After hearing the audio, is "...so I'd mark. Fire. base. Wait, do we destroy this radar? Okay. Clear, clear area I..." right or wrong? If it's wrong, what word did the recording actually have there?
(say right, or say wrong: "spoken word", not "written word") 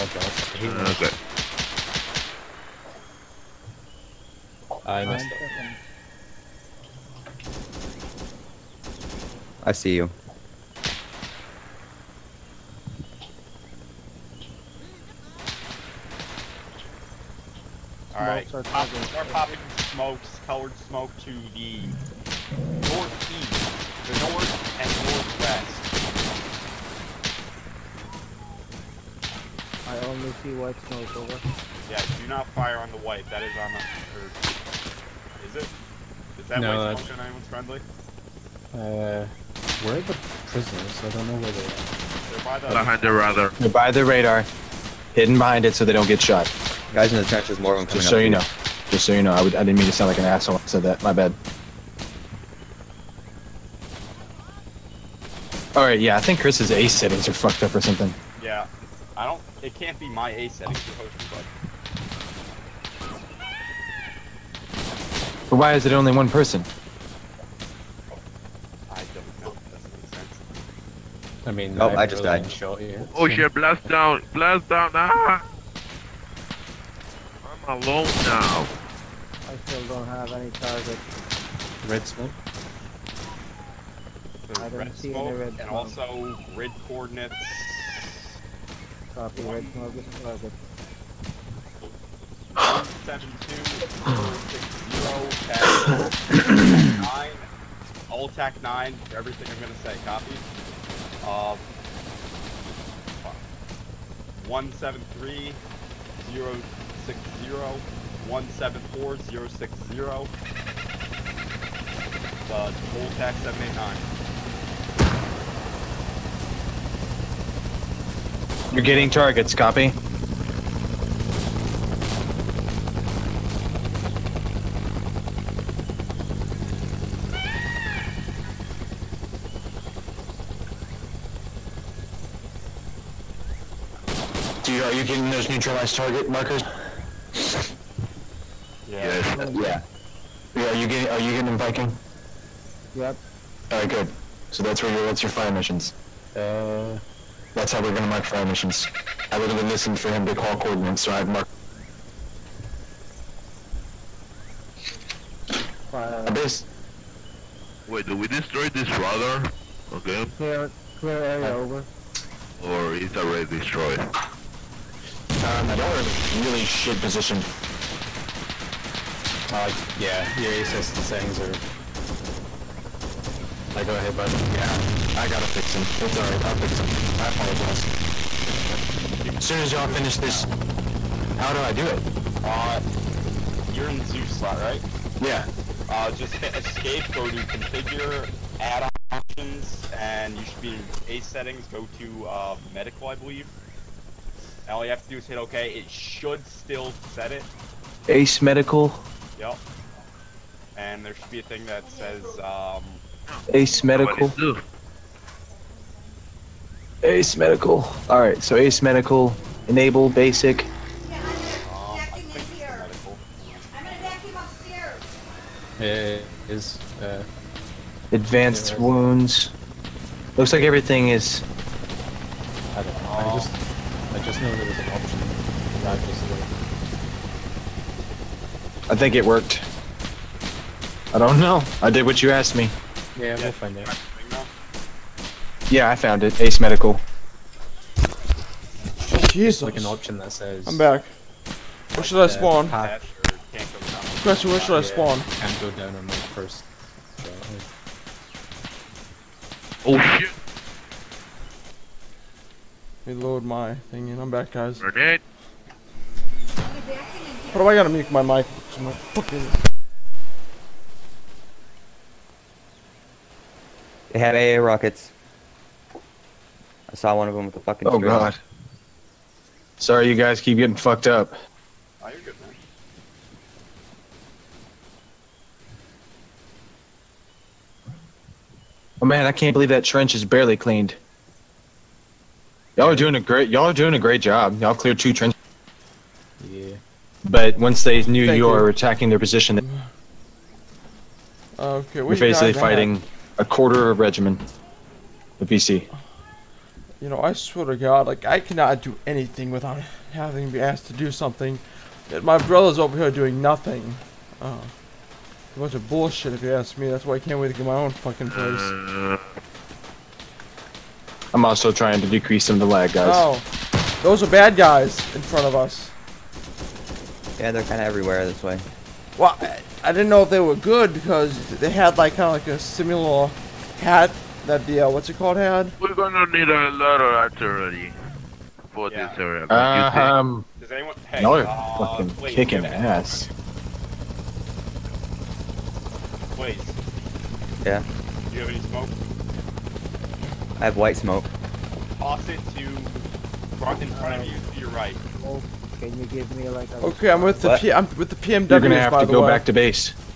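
right.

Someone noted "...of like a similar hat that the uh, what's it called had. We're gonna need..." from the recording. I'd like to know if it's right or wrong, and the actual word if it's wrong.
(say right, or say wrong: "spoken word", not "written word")
right.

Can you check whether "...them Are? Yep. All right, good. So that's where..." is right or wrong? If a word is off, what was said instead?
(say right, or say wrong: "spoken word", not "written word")
wrong: "Viking", not "Are".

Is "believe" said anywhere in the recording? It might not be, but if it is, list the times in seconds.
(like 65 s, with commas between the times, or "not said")
193 s, 279 s.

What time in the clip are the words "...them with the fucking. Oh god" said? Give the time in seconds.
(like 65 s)
267 s.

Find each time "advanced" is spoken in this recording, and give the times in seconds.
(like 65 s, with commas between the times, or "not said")
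218 s.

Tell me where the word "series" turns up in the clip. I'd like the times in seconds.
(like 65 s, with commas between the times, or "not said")
not said.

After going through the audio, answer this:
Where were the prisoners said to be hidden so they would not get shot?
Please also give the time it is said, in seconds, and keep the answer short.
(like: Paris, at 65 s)
Behind the radar, at 42 s.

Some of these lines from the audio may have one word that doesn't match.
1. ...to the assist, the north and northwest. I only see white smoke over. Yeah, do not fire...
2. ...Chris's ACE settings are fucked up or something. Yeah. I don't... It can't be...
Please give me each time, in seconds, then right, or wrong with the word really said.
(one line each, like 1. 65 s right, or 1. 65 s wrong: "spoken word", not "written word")
1. 21 s wrong: "northeast", not "assist"
2. 56 s right.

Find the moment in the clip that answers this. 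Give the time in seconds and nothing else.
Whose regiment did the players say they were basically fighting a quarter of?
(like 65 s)
295 s.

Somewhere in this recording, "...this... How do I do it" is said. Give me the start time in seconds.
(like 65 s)
180 s.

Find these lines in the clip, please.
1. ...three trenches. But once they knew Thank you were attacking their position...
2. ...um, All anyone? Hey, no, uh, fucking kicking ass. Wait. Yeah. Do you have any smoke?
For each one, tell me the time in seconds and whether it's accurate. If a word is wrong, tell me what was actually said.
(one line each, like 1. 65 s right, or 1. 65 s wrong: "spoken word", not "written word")
1. 284 s wrong: "two", not "three"
2. 329 s wrong: "Does", not "All".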